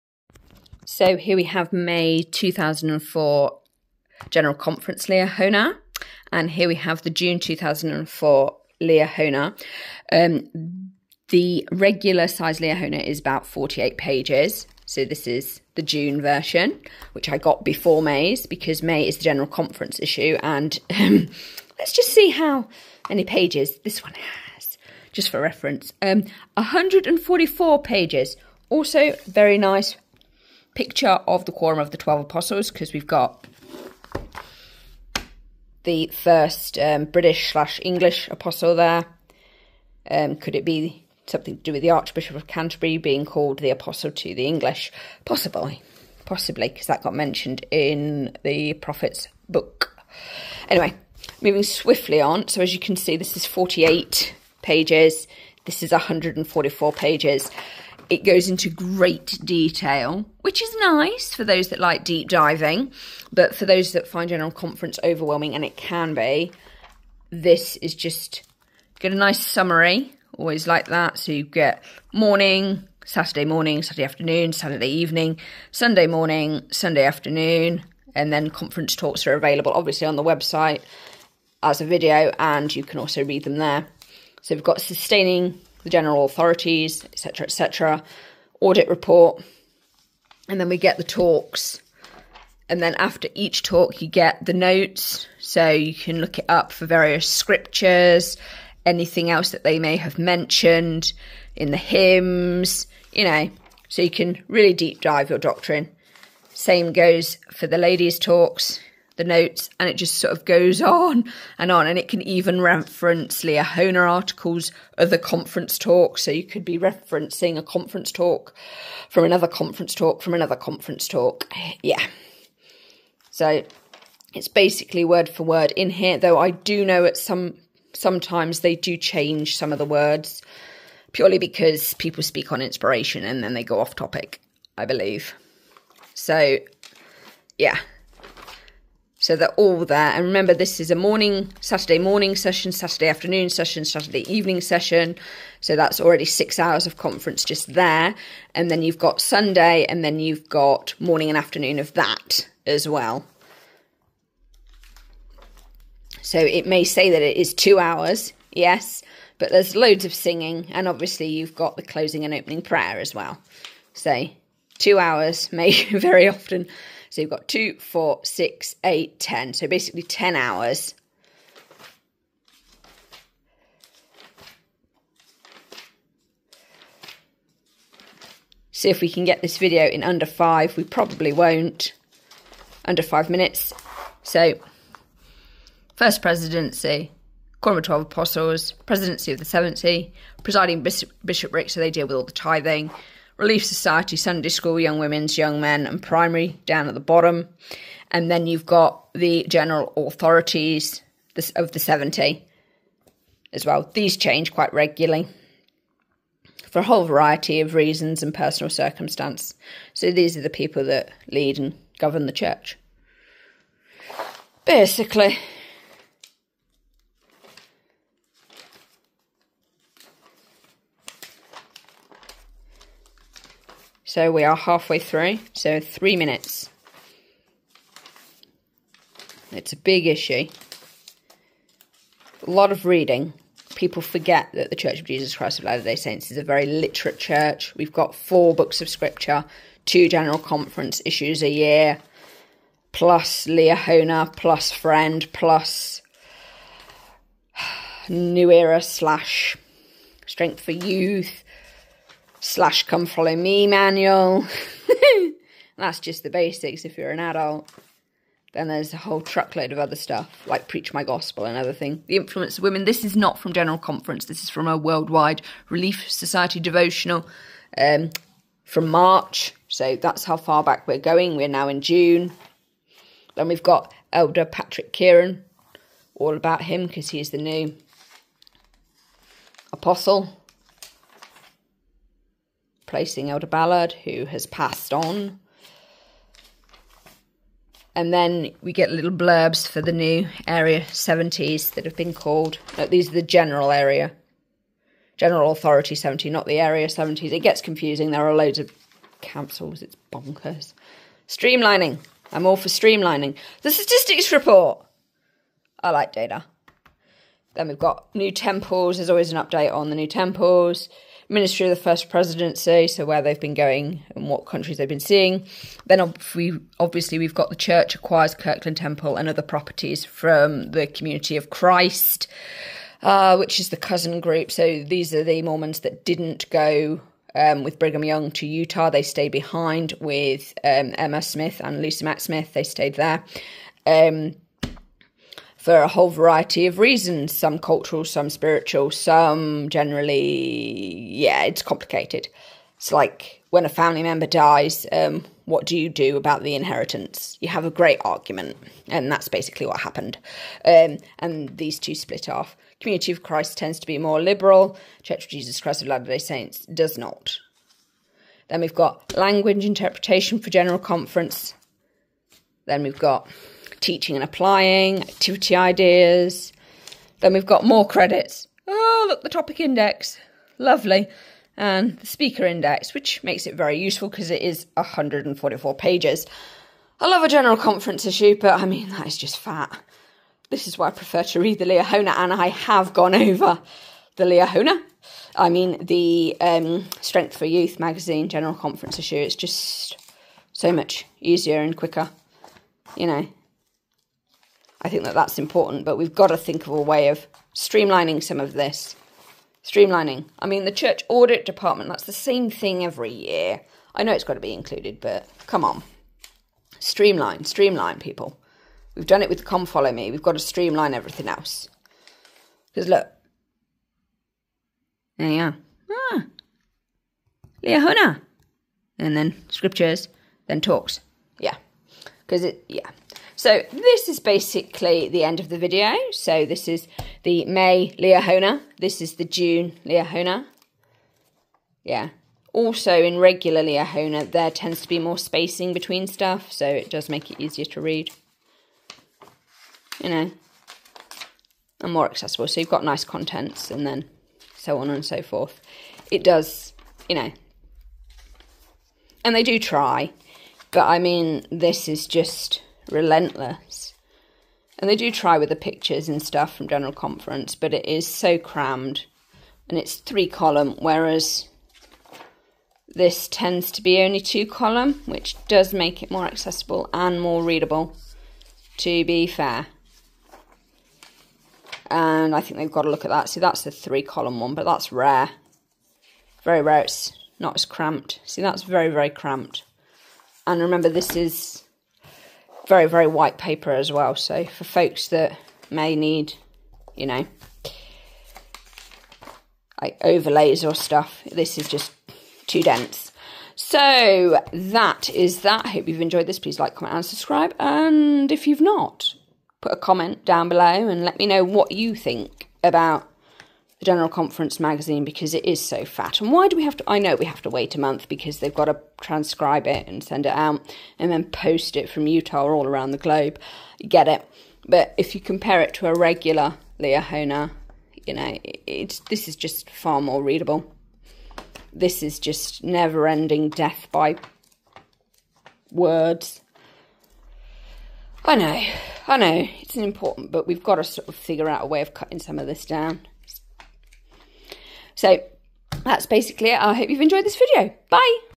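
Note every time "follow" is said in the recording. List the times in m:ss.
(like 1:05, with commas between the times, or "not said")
4:13, 6:49.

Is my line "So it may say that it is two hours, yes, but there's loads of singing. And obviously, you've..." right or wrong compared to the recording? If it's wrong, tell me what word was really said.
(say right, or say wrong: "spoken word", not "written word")
right.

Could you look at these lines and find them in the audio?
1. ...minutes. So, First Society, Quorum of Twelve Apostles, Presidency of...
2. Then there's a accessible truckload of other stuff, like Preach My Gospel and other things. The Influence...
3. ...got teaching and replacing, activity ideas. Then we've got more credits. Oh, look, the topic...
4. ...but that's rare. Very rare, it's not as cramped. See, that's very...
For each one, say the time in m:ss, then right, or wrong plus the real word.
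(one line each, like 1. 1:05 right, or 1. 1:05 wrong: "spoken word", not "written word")
1. 3:03 wrong: "Presidency", not "Society"
2. 4:18 wrong: "whole", not "accessible"
3. 6:02 wrong: "applying", not "replacing"
4. 7:54 right.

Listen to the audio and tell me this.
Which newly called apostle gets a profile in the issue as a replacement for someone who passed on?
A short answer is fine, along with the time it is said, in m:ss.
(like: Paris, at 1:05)
Patrick Kearon, at 4:34.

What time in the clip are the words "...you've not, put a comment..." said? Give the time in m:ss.
8:18.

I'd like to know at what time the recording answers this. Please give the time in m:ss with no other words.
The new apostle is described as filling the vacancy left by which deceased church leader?
4:43.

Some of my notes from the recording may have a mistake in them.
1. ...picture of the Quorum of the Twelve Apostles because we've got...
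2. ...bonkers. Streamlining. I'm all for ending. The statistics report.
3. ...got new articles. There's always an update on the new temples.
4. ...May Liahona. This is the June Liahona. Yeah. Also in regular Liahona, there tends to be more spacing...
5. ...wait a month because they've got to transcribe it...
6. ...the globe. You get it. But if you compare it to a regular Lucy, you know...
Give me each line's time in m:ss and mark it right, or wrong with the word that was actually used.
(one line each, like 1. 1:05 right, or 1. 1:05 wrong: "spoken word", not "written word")
1. 0:30 right
2. 5:00 wrong: "streamlining", not "ending"
3. 5:07 wrong: "temples", not "articles"
4. 7:07 right
5. 8:27 right
6. 8:32 wrong: "Liahona", not "Lucy".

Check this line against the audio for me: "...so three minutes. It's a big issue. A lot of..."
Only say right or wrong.
right.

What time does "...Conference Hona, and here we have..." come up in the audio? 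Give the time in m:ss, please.
0:04.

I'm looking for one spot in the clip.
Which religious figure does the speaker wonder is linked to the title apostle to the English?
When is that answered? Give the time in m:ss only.
0:41.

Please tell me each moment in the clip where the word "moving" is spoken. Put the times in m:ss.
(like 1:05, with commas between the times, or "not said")
0:51.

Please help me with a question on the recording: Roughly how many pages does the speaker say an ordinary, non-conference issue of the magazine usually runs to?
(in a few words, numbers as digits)
48.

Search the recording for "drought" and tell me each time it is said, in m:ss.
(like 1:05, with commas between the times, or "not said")
not said.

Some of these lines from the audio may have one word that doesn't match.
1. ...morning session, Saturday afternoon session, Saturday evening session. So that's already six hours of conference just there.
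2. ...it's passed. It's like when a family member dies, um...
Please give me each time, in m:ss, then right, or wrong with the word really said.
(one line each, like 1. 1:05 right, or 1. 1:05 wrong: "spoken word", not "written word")
1. 2:21 right
2. 5:41 wrong: "complicated", not "passed".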